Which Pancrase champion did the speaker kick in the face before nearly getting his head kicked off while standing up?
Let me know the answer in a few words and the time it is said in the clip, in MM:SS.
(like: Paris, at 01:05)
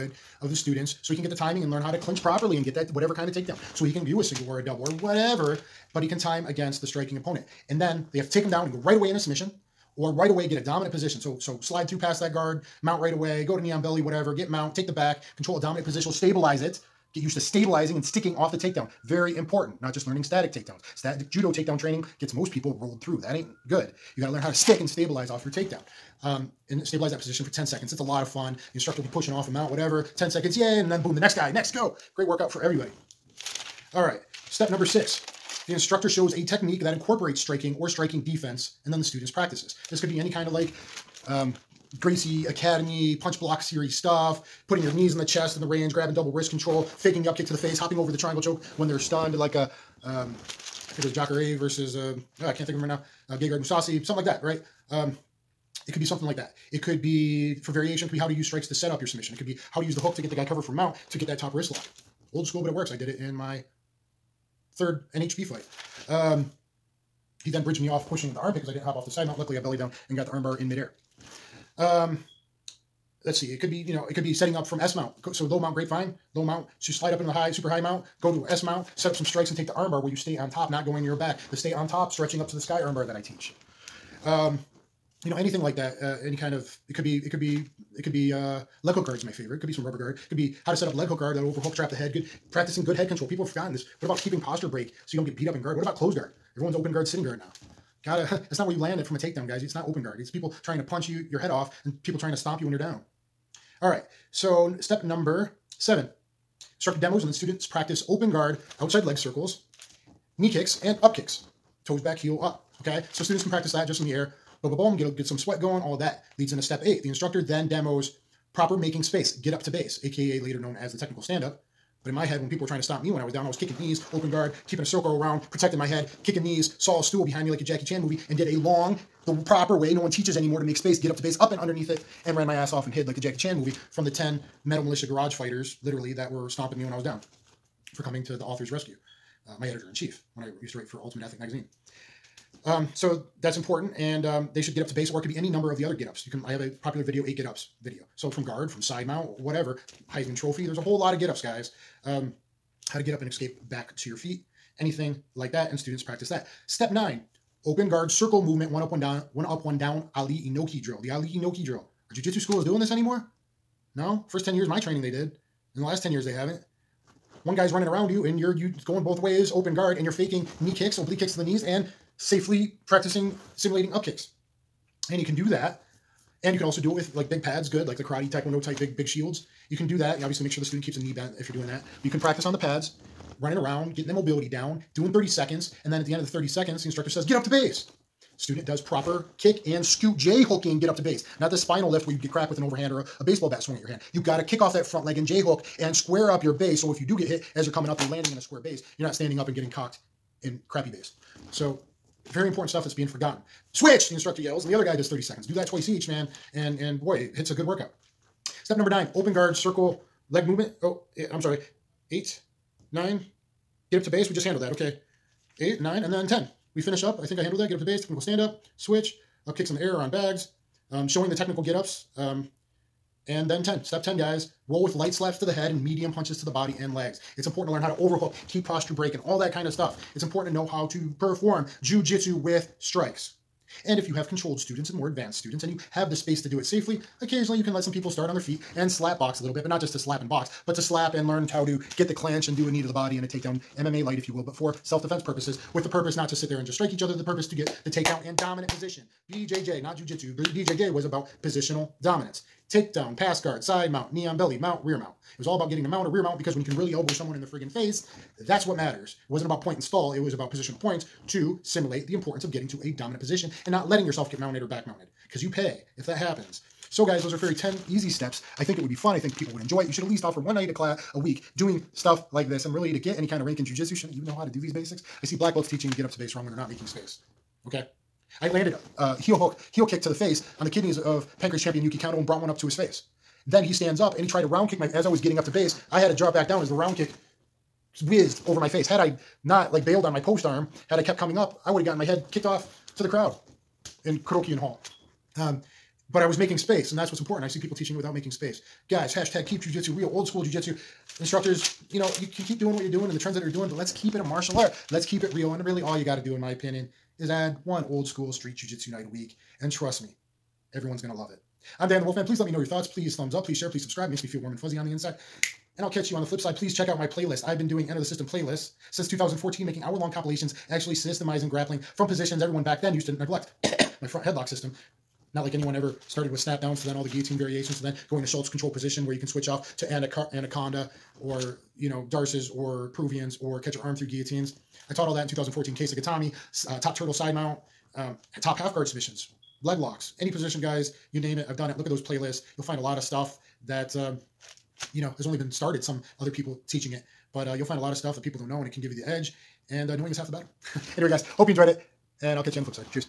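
Yuki Kondo, at 04:41.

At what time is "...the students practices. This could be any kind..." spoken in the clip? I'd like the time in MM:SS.
00:38.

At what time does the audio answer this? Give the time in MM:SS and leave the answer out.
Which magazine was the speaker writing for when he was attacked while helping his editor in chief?
02:21.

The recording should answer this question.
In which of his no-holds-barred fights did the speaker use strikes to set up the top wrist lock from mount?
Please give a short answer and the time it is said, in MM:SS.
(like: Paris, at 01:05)
third, at 01:04.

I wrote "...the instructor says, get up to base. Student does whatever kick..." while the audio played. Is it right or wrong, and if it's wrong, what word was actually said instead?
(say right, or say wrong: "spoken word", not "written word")
wrong: "proper", not "whatever".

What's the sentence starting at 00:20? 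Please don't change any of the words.
Static judo takedown training gets most people rolled through.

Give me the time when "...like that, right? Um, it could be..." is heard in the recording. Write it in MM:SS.
00:54.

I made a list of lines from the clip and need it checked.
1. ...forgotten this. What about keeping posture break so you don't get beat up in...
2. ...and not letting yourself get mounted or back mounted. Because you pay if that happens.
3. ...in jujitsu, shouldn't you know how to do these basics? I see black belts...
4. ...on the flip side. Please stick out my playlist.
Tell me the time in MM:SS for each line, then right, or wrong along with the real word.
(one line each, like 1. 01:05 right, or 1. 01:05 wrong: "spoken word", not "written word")
1. 01:33 right
2. 04:23 right
3. 04:33 right
4. 05:16 wrong: "check", not "stick".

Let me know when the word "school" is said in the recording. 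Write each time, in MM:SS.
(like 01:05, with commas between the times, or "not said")
01:02, 02:42, 05:00, 05:08.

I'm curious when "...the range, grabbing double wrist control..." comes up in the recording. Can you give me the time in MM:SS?
00:45.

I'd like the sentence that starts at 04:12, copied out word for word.
Takedown, pass guard, side mount, knee on belly, mount, rear mount.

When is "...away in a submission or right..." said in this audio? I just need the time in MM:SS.
00:08.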